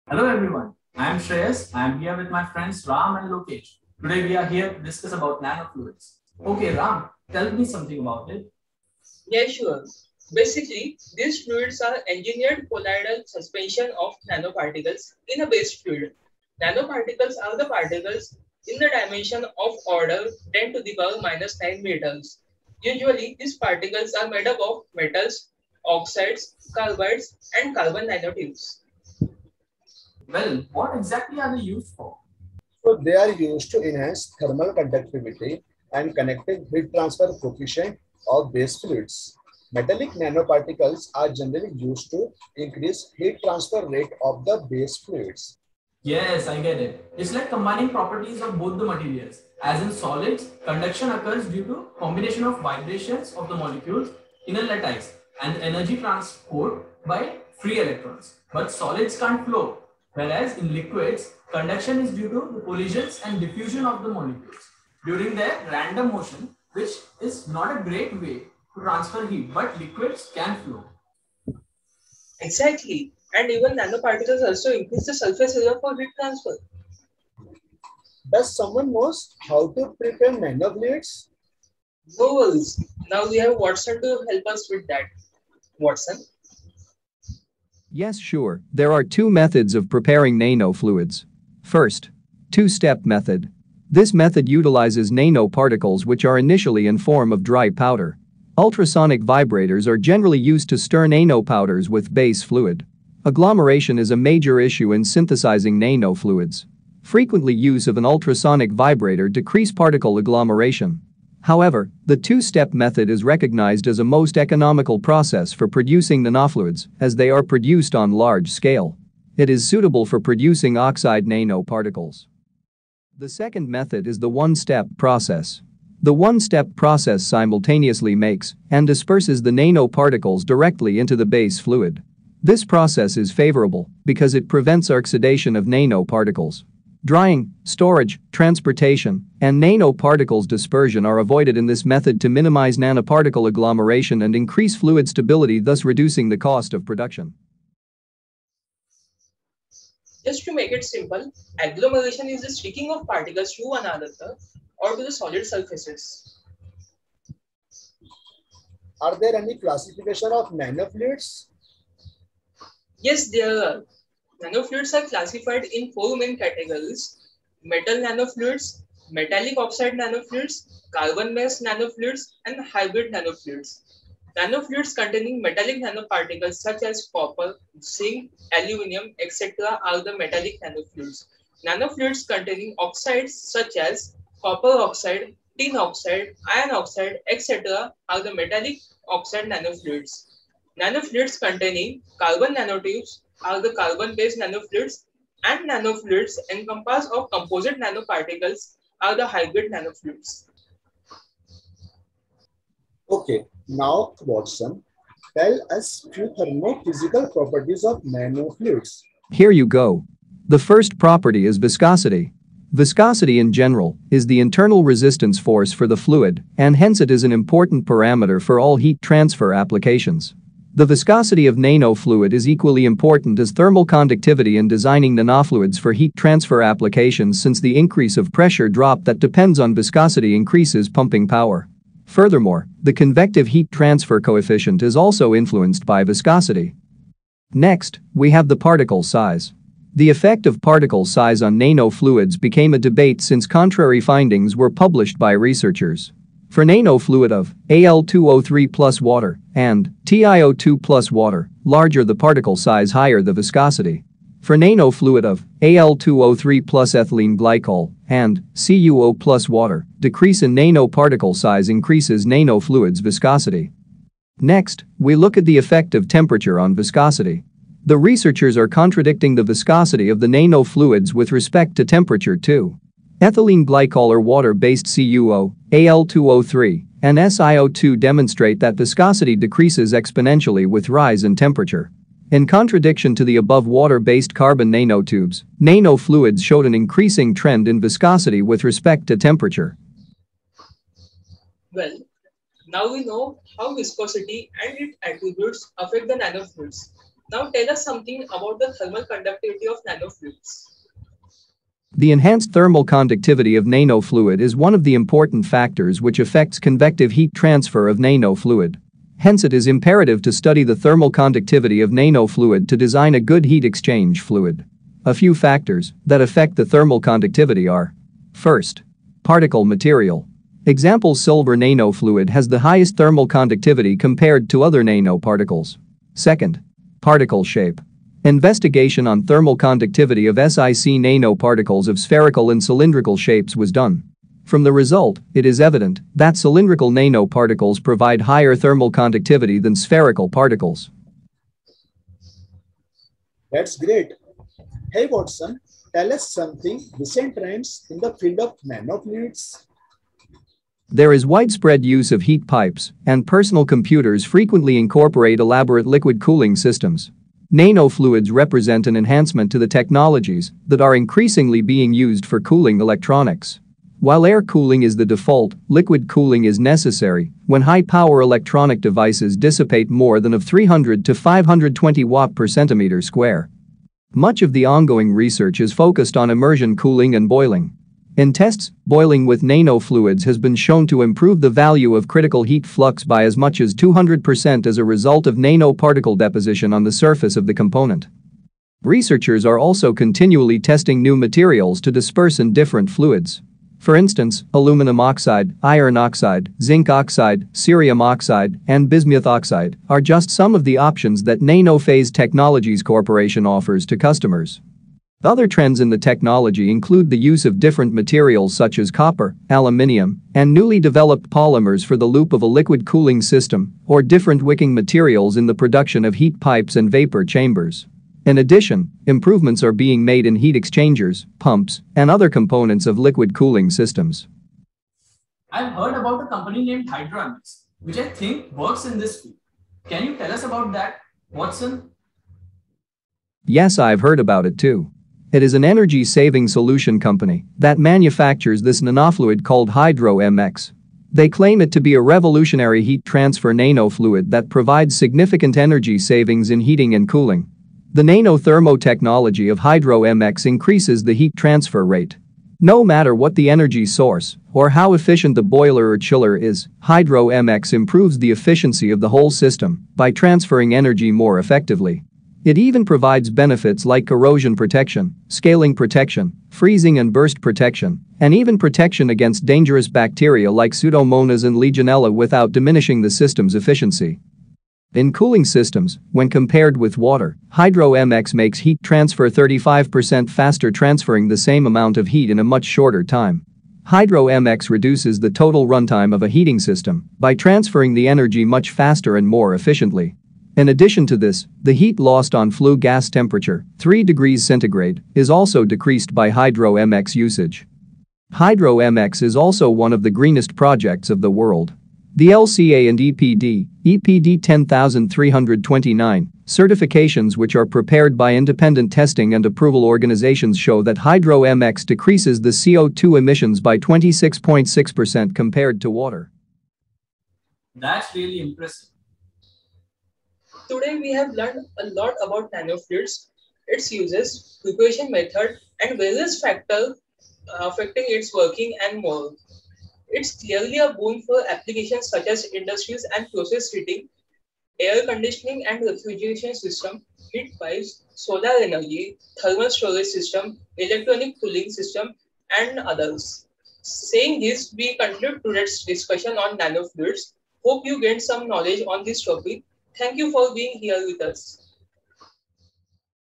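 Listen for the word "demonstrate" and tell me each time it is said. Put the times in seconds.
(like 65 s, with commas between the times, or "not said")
277 s.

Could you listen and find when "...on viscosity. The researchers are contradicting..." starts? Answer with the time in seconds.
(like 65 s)
266 s.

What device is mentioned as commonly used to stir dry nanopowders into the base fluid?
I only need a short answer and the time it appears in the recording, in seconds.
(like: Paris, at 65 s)
Ultrasonic vibrators, at 98 s.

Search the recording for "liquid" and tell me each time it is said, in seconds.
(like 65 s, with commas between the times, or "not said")
60 s, 69 s, 355 s, 365 s, 412 s, 422 s.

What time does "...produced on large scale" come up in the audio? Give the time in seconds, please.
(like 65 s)
117 s.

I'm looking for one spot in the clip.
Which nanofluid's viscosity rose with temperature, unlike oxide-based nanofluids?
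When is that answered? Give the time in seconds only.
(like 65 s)
283 s.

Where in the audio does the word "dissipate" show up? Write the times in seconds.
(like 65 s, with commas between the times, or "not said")
369 s.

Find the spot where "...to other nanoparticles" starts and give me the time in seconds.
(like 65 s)
324 s.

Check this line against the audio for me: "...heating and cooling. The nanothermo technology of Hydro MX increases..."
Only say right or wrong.
right.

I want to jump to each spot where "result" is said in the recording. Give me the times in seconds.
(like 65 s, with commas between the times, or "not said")
334 s, 384 s.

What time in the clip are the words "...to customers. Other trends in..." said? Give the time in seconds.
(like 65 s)
403 s.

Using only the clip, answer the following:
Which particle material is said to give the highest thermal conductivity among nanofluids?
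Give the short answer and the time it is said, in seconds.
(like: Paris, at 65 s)
Silver, at 321 s.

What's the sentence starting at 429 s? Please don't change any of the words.
Can you tell us about that, Watson?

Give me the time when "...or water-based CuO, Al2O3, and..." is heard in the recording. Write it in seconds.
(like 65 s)
274 s.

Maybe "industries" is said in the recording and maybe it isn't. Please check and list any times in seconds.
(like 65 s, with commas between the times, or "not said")
532 s.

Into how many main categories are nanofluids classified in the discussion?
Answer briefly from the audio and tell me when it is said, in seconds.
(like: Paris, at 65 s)
4, at 165 s.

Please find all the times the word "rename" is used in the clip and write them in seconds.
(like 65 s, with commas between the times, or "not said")
not said.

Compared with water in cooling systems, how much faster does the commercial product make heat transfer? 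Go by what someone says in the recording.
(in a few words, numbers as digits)
35%.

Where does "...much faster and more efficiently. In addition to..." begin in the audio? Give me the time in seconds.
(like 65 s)
488 s.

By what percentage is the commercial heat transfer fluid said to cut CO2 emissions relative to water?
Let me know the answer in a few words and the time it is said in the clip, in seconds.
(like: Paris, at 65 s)
26.6%, at 513 s.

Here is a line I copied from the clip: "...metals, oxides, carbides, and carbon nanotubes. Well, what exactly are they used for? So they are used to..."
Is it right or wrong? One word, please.
right.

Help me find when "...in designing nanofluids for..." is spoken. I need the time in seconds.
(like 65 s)
224 s.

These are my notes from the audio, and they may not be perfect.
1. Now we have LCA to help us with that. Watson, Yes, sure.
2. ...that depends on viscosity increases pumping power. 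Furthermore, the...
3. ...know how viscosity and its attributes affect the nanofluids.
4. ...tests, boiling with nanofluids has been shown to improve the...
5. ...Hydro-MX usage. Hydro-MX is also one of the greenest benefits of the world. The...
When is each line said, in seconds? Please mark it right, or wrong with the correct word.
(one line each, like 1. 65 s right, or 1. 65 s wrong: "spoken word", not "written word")
1. 83 s wrong: "Watson", not "LCA"
2. 229 s right
3. 293 s right
4. 378 s right
5. 496 s wrong: "projects", not "benefits".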